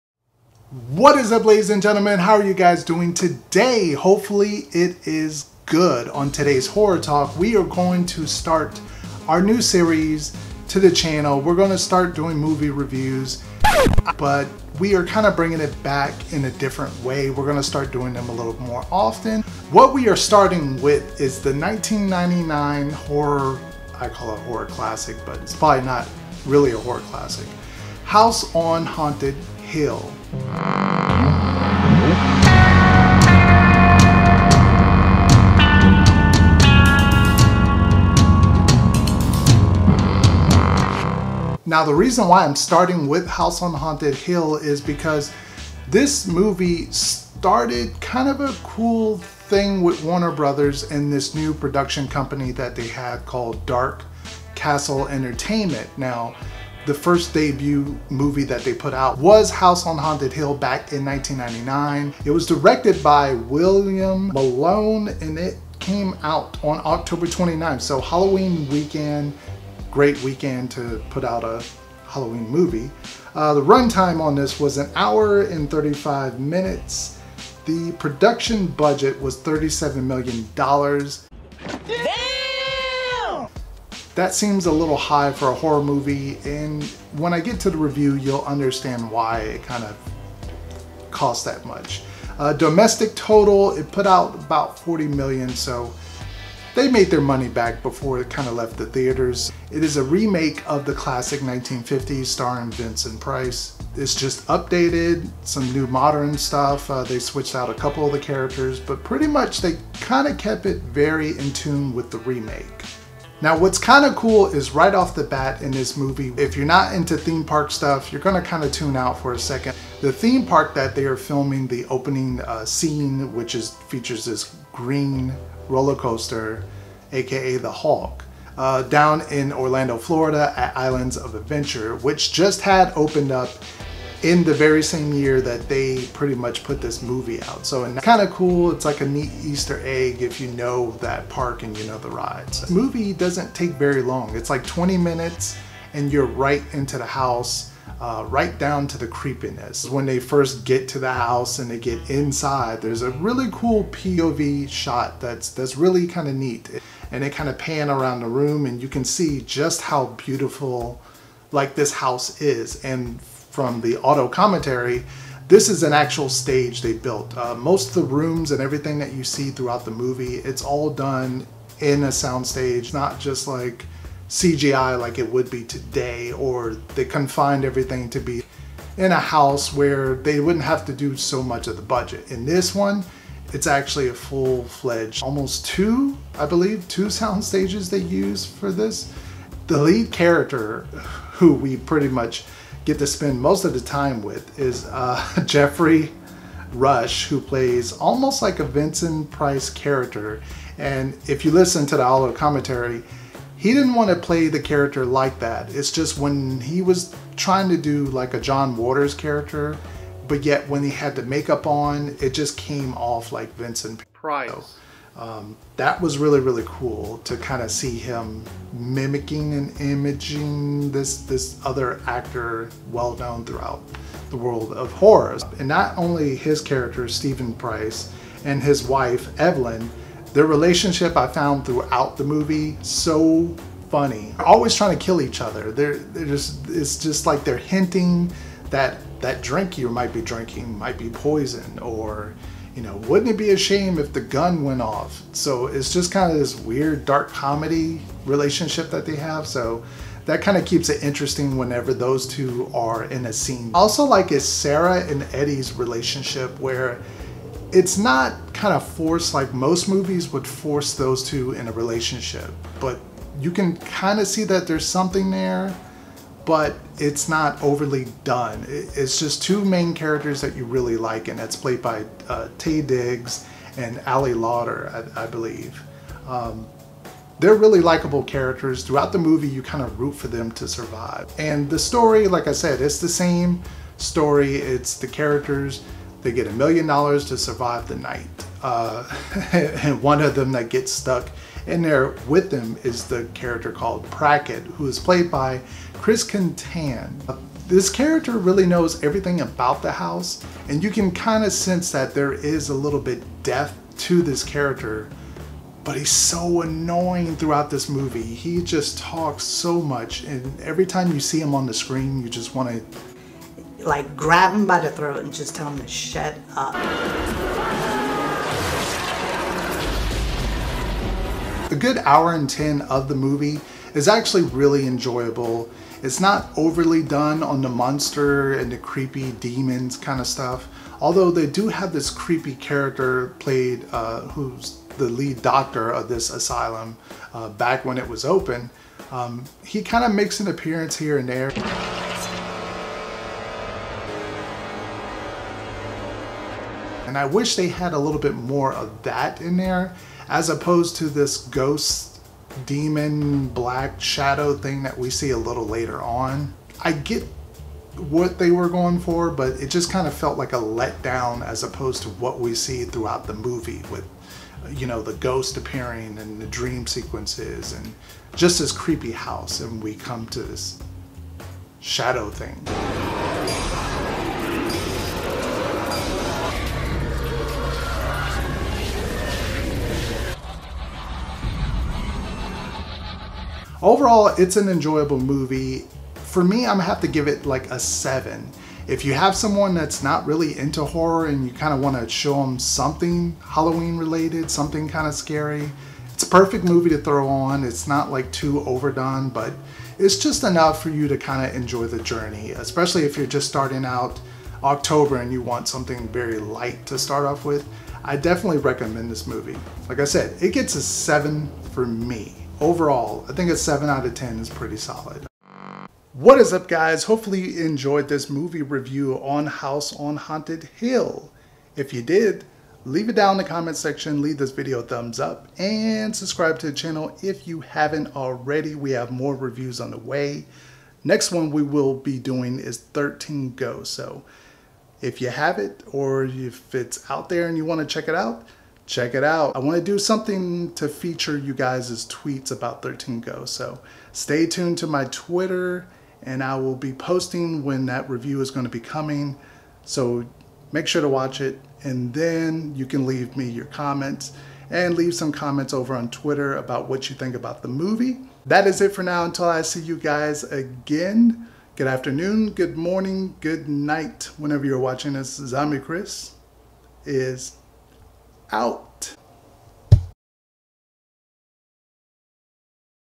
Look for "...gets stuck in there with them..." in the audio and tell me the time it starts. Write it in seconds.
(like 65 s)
290 s.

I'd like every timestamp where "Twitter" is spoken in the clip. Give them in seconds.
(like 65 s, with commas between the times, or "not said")
445 s, 456 s.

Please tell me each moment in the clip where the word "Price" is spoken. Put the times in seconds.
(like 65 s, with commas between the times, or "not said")
103 s, 199 s, 214 s, 227 s.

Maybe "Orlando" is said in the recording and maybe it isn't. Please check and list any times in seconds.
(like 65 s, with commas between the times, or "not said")
129 s.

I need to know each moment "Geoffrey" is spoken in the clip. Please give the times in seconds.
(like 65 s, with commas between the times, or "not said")
195 s.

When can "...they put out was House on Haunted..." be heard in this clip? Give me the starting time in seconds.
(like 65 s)
58 s.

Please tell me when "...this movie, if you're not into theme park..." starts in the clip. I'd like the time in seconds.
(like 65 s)
115 s.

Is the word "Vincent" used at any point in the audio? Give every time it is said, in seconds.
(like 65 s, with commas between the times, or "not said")
102 s, 198 s, 213 s.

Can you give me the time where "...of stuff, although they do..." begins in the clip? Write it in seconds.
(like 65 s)
330 s.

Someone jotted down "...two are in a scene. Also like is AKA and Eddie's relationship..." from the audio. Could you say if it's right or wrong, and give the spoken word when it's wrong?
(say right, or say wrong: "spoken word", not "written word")
wrong: "Sarah", not "AKA".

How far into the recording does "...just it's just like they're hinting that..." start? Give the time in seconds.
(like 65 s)
236 s.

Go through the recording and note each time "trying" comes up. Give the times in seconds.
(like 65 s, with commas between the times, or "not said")
207 s, 234 s.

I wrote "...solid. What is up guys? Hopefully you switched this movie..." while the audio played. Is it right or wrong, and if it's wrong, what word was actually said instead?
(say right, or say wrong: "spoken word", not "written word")
wrong: "enjoyed", not "switched".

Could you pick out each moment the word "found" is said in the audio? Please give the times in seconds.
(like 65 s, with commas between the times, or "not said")
231 s.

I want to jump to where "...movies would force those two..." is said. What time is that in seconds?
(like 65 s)
259 s.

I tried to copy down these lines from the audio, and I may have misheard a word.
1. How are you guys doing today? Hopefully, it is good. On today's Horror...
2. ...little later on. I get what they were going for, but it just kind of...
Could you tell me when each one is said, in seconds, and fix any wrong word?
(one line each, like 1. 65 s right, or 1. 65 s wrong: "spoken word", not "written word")
1. 2 s right
2. 355 s right.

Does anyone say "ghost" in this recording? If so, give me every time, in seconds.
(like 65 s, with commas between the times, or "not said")
351 s, 365 s.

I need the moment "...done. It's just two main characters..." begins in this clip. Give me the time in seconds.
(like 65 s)
268 s.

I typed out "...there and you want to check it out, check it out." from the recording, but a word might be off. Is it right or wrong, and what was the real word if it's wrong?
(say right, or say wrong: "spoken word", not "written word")
right.